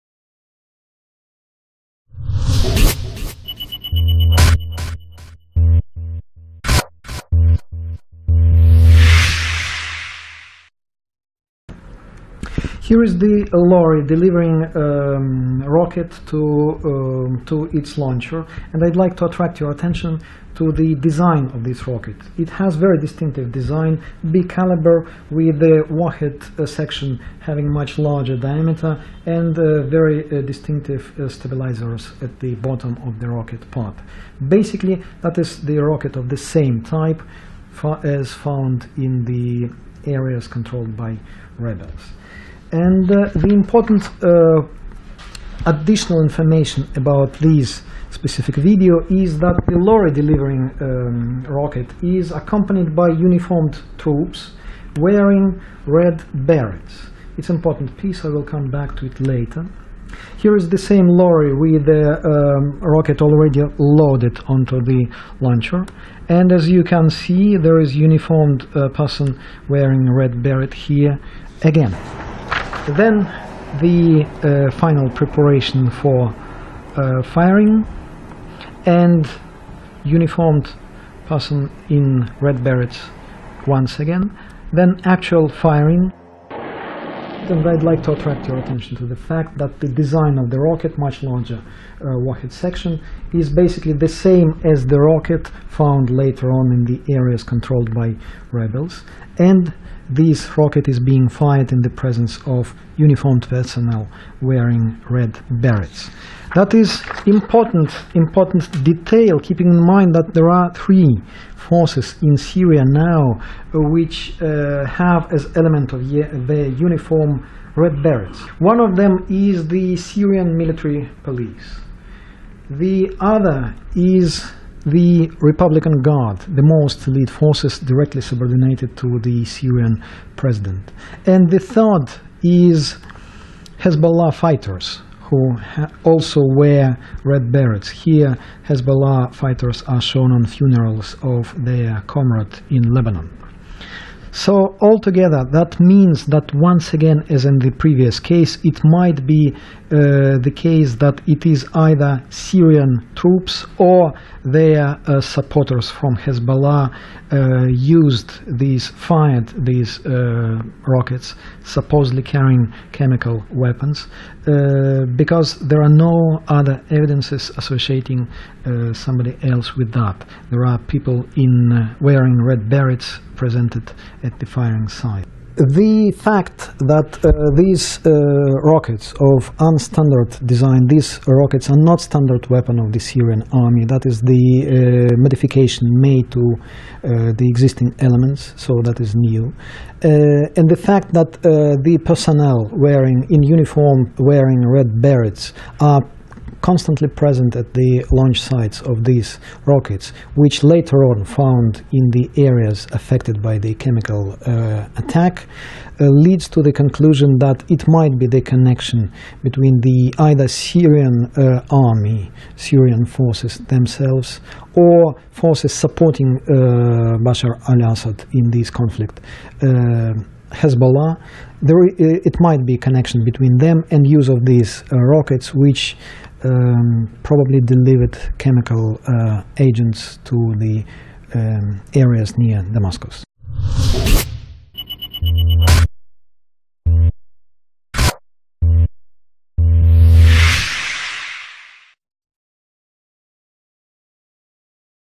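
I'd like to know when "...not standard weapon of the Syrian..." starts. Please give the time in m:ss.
3:01.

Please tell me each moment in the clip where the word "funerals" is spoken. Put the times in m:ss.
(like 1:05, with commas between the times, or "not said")
2:20.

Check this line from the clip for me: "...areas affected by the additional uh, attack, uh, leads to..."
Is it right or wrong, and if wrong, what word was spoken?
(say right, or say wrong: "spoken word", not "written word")
wrong: "chemical", not "additional".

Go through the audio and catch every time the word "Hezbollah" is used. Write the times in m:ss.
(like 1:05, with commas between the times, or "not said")
2:13, 2:18, 2:36, 3:40.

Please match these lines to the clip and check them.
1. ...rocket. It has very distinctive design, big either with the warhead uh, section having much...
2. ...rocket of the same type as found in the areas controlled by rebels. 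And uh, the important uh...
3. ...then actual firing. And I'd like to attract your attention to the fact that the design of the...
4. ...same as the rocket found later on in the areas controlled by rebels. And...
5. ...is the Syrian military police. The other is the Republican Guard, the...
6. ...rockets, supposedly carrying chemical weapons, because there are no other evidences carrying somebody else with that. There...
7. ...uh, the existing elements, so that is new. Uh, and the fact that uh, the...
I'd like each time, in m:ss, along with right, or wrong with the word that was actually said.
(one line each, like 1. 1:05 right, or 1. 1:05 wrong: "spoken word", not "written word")
1. 0:21 wrong: "caliber", not "either"
2. 0:35 right
3. 1:24 right
4. 1:34 right
5. 1:59 right
6. 2:40 wrong: "associating", not "carrying"
7. 3:06 right.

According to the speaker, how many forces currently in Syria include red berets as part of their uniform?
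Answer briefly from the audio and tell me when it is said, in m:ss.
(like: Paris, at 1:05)
3, at 1:50.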